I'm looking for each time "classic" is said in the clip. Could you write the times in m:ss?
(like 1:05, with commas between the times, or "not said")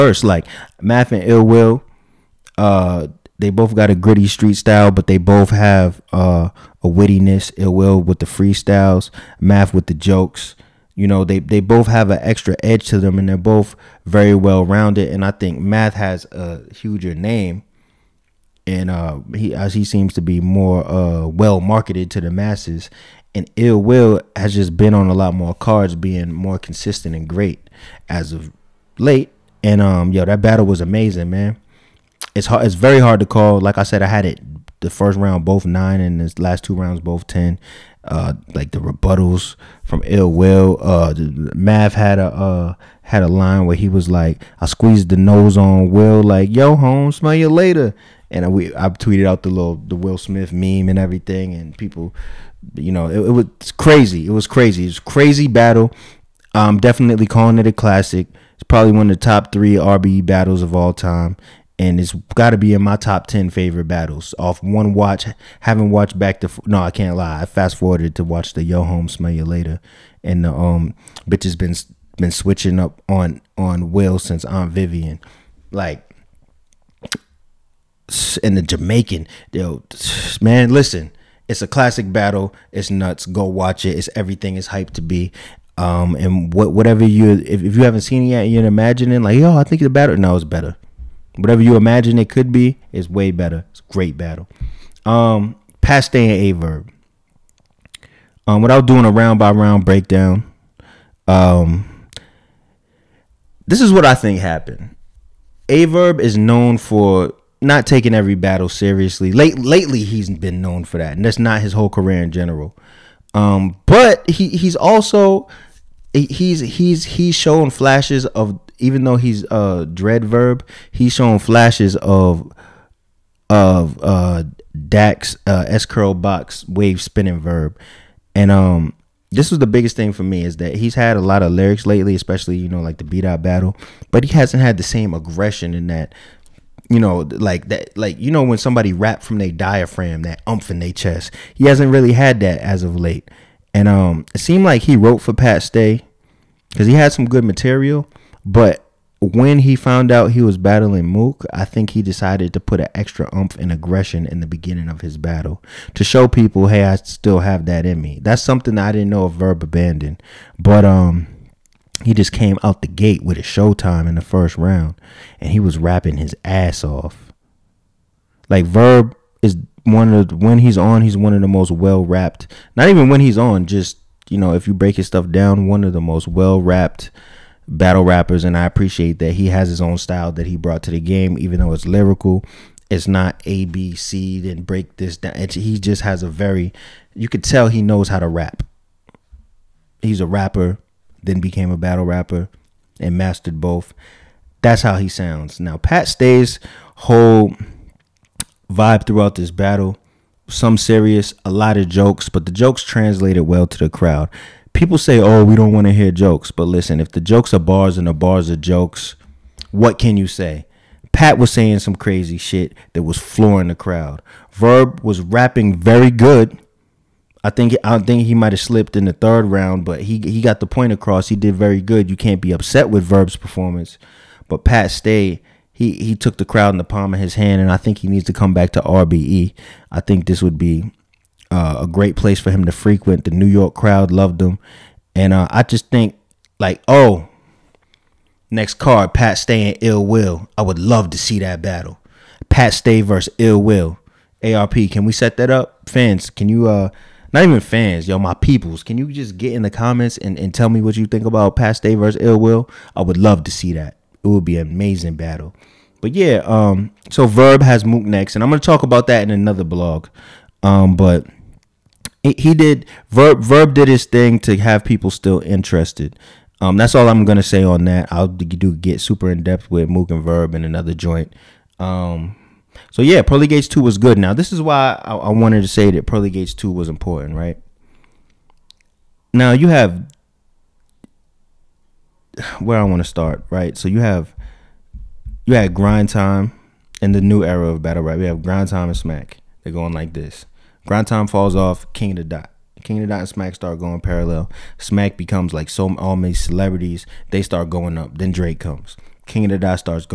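0:57, 1:21.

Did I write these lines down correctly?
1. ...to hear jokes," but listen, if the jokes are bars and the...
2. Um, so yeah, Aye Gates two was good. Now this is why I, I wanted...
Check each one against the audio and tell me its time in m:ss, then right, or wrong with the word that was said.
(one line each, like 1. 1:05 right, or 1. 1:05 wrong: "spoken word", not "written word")
1. 3:25 right
2. 4:31 wrong: "Pearly", not "Aye".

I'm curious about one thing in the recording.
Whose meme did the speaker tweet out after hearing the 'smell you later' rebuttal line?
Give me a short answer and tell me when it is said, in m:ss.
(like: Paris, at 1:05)
Will Smith, at 0:49.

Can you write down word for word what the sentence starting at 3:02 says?
It's not A B C then break this down.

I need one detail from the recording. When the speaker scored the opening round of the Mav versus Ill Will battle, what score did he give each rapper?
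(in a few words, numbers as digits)
9.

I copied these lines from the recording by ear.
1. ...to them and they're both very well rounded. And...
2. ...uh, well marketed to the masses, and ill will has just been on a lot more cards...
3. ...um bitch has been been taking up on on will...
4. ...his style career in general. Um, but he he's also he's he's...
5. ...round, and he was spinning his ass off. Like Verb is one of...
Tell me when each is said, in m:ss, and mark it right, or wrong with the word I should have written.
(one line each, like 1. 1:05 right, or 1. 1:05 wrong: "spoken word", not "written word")
1. 0:12 right
2. 0:20 right
3. 1:10 wrong: "switching", not "taking"
4. 1:51 wrong: "whole", not "style"
5. 2:44 wrong: "rapping", not "spinning".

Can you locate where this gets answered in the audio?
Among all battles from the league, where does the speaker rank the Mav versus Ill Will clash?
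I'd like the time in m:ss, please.
0:59.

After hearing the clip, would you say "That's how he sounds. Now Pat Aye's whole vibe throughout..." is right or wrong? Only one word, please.
wrong.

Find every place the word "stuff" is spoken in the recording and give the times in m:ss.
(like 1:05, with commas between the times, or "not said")
2:55.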